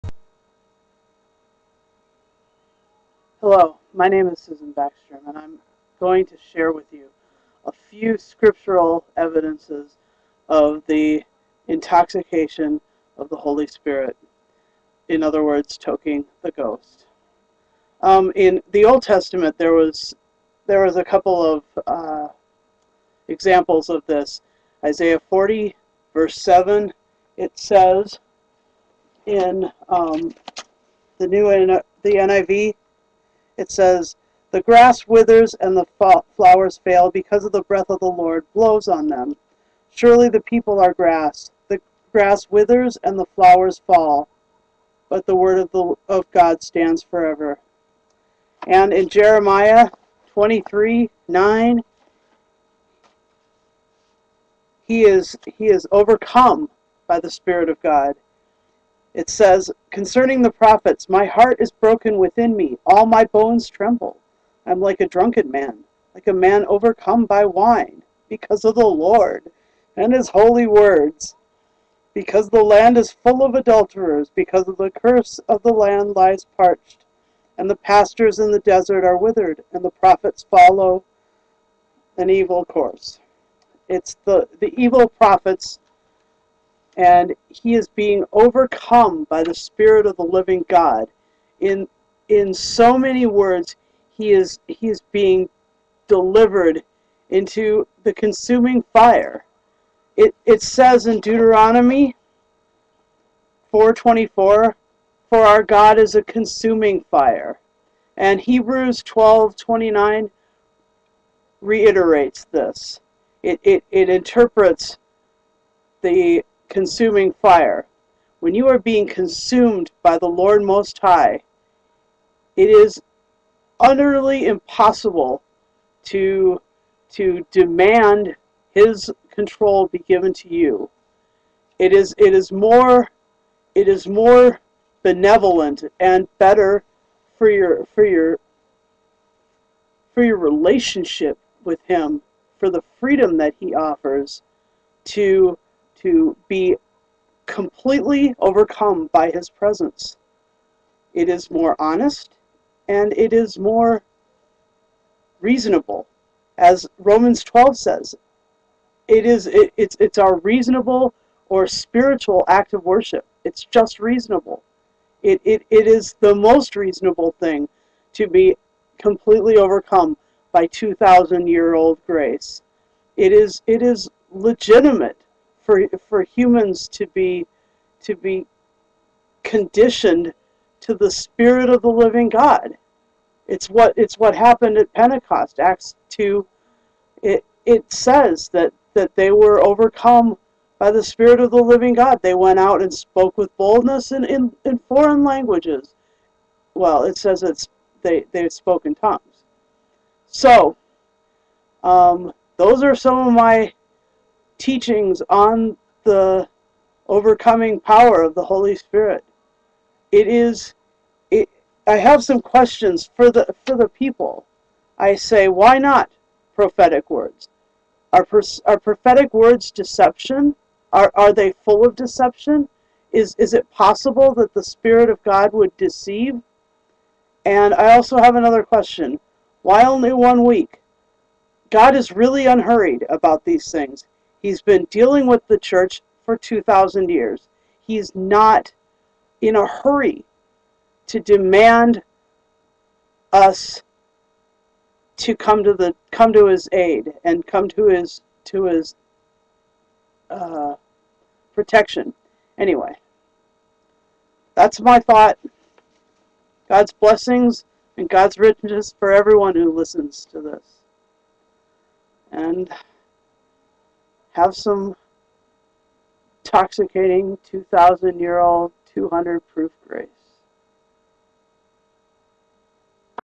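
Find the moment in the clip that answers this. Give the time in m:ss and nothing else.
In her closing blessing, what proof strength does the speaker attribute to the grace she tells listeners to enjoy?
4:28.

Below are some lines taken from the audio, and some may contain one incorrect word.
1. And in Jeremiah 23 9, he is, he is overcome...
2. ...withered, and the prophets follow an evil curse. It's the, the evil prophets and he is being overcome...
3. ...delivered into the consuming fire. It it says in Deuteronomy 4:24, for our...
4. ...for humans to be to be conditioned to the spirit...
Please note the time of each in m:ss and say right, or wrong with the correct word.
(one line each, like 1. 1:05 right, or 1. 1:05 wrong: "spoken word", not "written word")
1. 0:48 right
2. 1:19 wrong: "course", not "curse"
3. 1:36 right
4. 2:56 right.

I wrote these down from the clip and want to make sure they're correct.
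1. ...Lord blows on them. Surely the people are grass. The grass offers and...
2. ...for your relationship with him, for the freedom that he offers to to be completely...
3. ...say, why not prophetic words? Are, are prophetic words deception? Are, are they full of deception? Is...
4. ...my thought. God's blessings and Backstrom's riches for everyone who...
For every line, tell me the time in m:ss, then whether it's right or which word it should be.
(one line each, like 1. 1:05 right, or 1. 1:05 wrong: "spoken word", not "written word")
1. 0:38 wrong: "withers", not "offers"
2. 2:20 right
3. 3:35 right
4. 4:14 wrong: "God", not "Backstrom".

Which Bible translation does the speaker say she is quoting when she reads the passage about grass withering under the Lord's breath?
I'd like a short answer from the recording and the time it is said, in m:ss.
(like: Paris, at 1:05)
NIV, at 0:32.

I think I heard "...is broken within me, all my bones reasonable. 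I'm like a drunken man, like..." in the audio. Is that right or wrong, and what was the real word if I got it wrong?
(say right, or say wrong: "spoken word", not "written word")
wrong: "tremble", not "reasonable".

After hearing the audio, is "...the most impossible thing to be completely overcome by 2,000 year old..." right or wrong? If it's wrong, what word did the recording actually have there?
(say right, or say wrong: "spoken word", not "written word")
wrong: "reasonable", not "impossible".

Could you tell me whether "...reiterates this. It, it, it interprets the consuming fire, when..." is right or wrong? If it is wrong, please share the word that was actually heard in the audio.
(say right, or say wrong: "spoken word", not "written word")
right.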